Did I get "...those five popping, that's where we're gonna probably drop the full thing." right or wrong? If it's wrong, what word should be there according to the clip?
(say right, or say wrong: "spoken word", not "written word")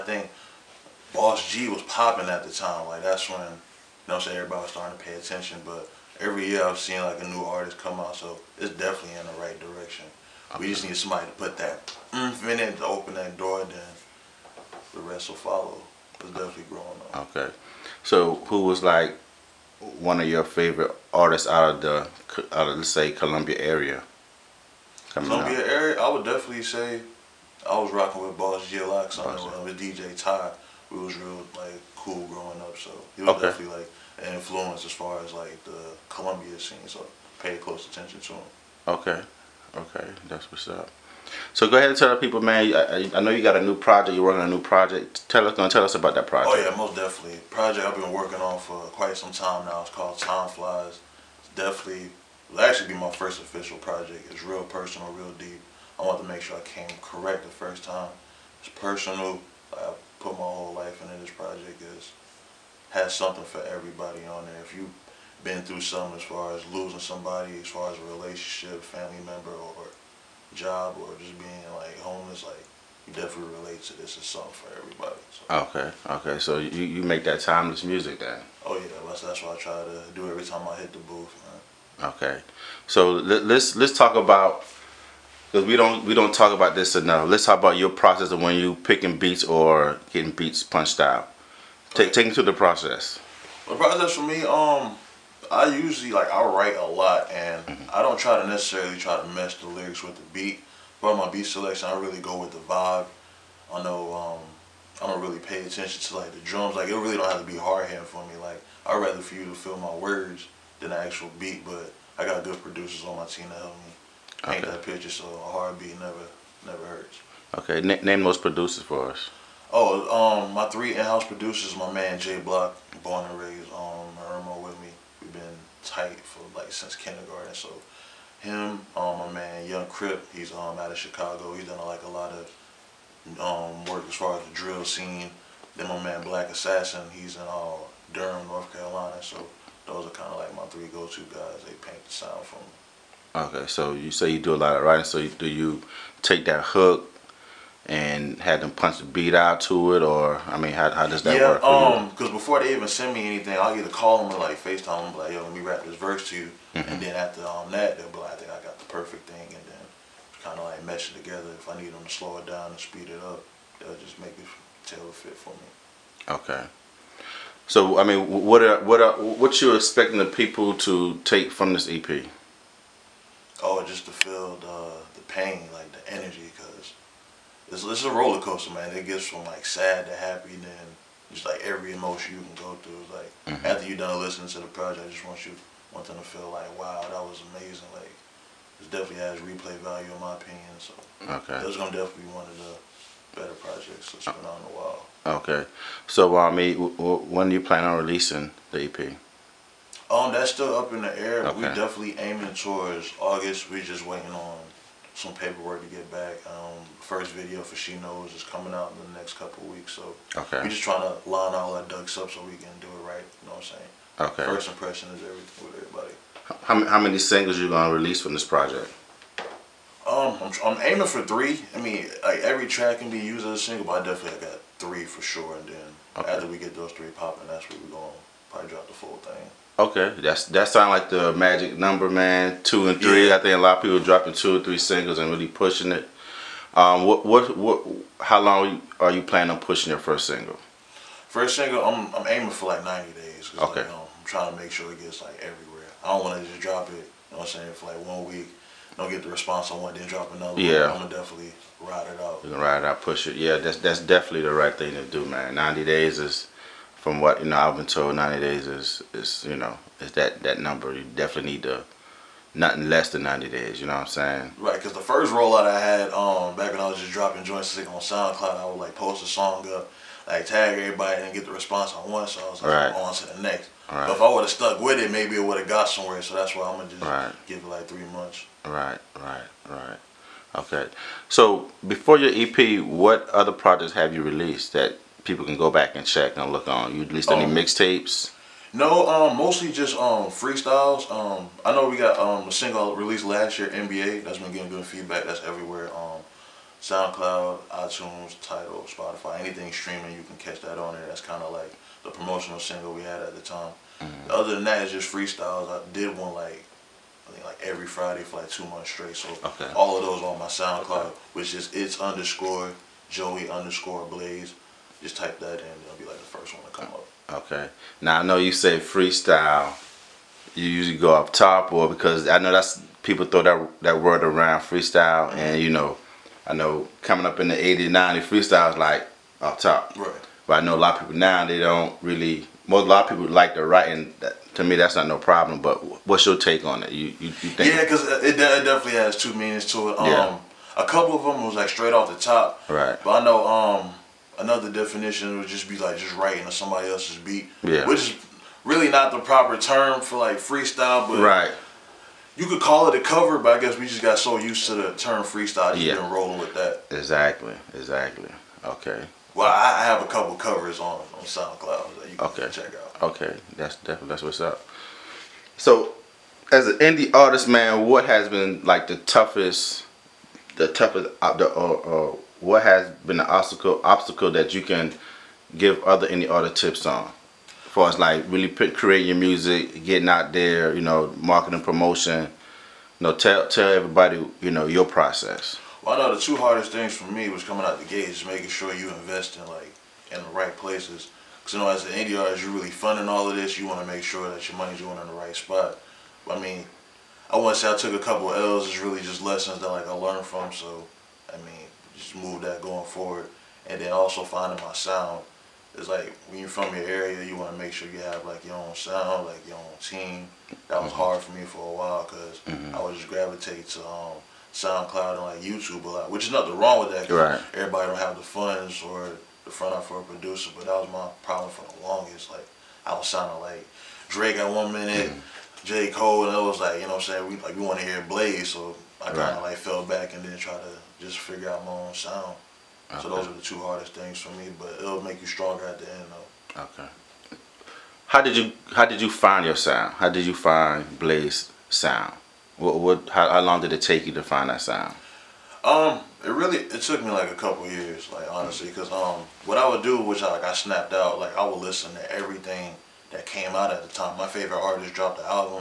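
wrong: "three", not "five".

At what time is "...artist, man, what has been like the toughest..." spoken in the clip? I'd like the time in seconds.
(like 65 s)
367 s.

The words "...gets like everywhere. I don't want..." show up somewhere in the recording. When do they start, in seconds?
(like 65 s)
245 s.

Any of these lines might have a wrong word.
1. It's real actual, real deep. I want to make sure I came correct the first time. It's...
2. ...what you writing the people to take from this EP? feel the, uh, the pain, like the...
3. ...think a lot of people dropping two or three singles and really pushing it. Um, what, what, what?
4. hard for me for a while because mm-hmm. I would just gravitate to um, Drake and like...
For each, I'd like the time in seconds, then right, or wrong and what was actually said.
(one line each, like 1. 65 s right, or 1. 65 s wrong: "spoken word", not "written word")
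1. 54 s wrong: "personal", not "actual"
2. 169 s wrong: "expecting", not "writing"
3. 233 s right
4. 411 s wrong: "SoundCloud", not "Drake".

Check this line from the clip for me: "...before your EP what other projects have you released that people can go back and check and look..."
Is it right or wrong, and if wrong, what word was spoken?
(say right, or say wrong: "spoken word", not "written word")
right.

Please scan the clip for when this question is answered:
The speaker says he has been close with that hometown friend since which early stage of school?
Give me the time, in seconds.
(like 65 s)
126 s.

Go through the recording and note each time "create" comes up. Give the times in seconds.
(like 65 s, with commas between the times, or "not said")
378 s.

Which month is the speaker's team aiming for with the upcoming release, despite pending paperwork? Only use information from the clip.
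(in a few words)
August.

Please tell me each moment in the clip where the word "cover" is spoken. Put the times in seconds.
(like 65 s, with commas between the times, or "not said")
352 s, 360 s.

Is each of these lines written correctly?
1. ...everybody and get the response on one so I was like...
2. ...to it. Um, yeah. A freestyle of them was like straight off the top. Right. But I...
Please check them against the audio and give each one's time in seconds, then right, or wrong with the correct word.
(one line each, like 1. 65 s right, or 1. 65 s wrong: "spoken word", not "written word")
1. 270 s right
2. 339 s wrong: "couple", not "freestyle".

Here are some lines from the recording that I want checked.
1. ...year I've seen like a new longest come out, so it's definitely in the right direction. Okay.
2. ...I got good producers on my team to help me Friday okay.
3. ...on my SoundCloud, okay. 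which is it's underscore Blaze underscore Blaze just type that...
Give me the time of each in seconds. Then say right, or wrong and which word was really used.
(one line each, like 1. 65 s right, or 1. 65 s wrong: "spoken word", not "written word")
1. 6 s wrong: "artist", not "longest"
2. 112 s wrong: "Paint", not "Friday"
3. 310 s wrong: "Joey", not "Blaze".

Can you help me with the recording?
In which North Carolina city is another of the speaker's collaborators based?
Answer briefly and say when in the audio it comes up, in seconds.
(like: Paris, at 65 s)
Durham, at 138 s.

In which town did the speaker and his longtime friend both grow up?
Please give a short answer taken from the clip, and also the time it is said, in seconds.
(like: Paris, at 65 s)
Irmo, at 124 s.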